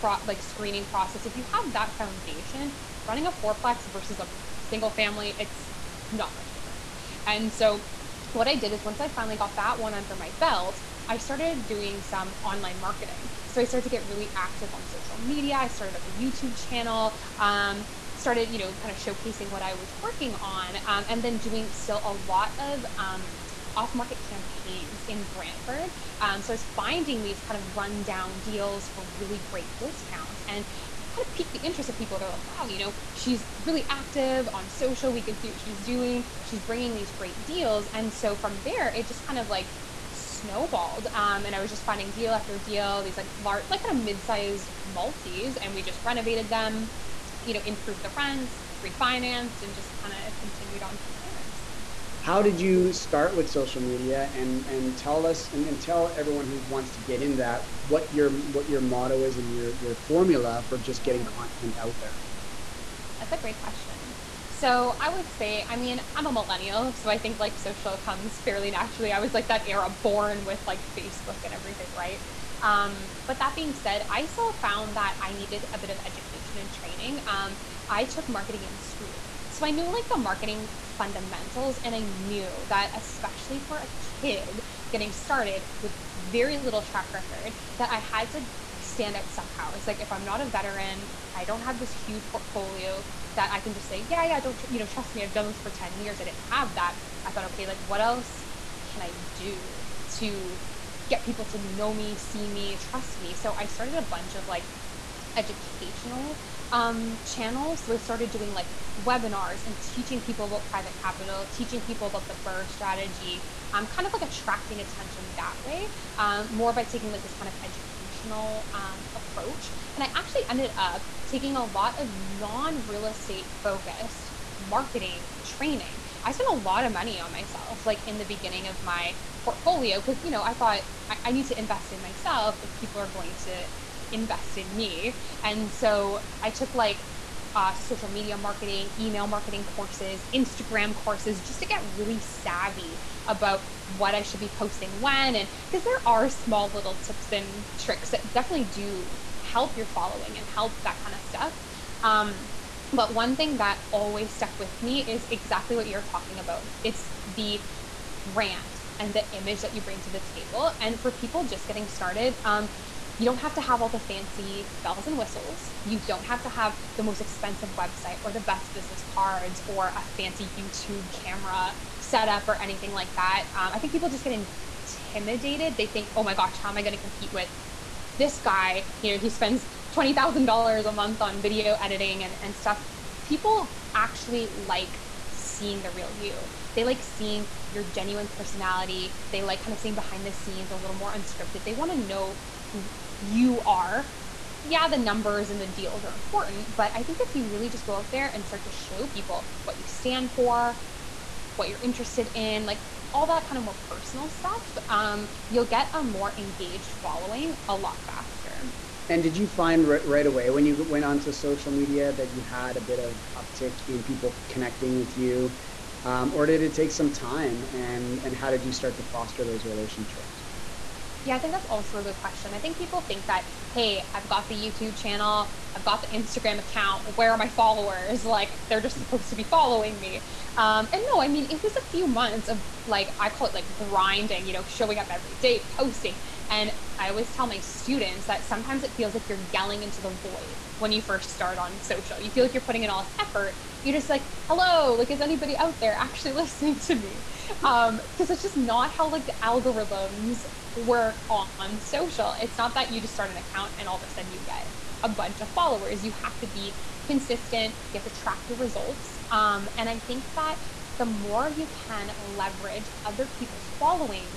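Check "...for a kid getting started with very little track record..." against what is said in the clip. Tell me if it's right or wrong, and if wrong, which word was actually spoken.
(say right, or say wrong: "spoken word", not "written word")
right.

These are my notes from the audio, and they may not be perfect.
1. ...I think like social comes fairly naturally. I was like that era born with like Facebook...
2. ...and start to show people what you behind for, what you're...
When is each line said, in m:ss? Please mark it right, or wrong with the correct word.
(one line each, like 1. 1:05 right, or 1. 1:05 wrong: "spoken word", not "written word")
1. 1:07 right
2. 3:18 wrong: "stand", not "behind".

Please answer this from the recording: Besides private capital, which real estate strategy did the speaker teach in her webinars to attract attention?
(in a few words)
BRRRR strategy.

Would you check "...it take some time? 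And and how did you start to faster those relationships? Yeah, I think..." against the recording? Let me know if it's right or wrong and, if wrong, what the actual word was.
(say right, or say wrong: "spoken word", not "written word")
wrong: "foster", not "faster".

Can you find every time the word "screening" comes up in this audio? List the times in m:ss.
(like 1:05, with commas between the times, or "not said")
0:00.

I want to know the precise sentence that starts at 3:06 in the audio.
They like seeing your genuine personality.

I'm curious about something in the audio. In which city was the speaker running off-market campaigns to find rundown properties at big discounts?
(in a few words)
Brantford.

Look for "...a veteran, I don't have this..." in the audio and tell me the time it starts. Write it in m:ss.
1:30.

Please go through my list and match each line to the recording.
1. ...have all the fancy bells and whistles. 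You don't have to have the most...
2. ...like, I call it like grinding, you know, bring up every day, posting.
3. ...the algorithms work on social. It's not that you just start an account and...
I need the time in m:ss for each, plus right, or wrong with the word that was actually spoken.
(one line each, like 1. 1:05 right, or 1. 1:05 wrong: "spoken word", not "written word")
1. 2:43 right
2. 3:52 wrong: "showing", not "bring"
3. 4:09 right.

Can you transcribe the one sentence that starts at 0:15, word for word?
I started up a YouTube channel.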